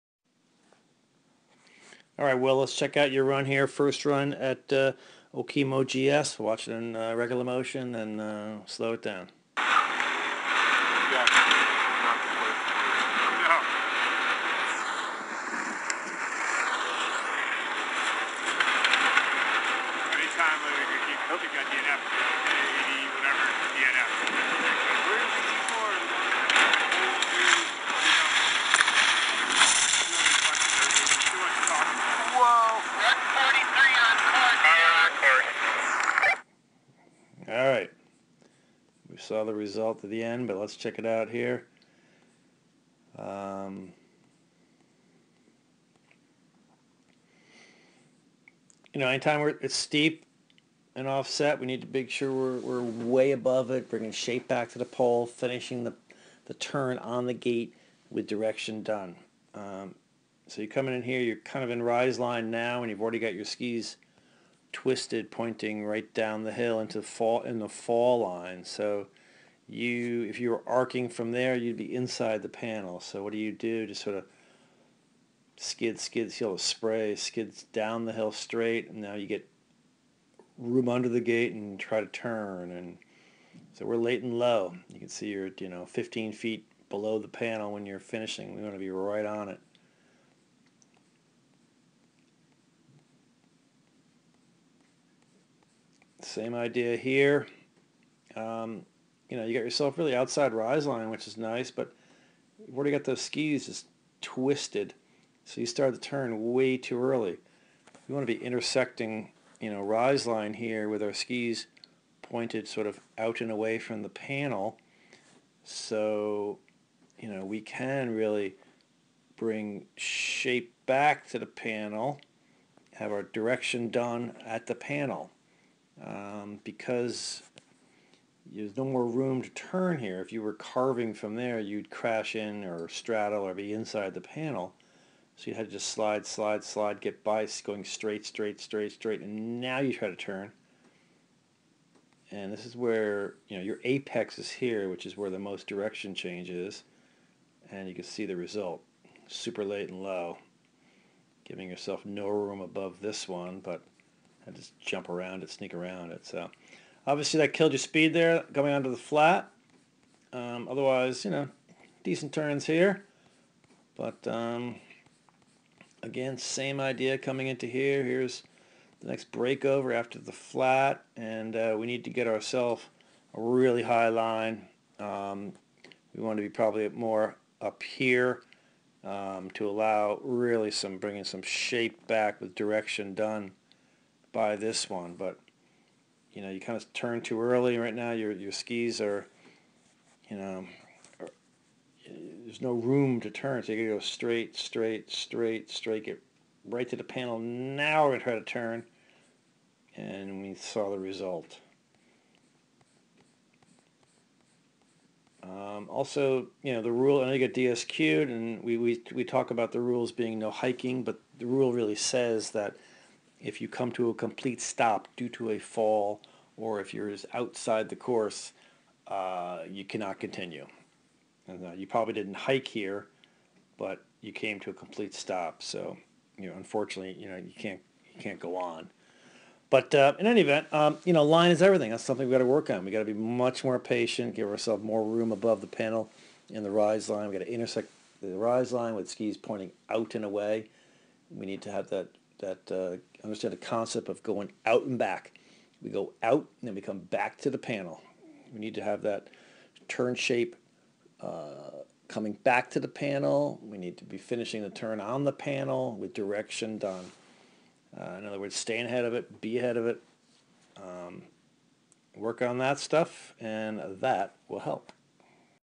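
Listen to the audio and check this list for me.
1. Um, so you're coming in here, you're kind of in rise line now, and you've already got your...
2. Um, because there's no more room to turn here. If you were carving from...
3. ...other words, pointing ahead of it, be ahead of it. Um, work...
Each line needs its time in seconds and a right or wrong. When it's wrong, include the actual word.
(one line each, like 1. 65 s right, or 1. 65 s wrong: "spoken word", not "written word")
1. 59 s right
2. 126 s right
3. 258 s wrong: "staying", not "pointing".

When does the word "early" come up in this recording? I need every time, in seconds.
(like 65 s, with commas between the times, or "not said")
107 s, 187 s.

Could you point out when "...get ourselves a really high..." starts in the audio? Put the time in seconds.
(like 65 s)
172 s.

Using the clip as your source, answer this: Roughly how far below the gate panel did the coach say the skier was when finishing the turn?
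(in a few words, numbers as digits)
15 feet.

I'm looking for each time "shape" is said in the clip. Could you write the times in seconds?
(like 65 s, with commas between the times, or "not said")
54 s, 119 s, 181 s, 250 s.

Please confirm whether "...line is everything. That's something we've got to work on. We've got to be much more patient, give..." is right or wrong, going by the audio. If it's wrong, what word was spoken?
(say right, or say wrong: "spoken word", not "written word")
right.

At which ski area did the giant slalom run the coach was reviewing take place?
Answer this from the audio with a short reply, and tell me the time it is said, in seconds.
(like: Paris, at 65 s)
Okemo, at 5 s.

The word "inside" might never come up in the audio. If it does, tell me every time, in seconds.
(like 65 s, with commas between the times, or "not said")
71 s, 133 s.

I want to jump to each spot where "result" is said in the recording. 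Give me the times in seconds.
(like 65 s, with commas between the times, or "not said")
39 s, 148 s, 200 s.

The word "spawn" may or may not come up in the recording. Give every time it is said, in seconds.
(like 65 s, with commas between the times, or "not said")
not said.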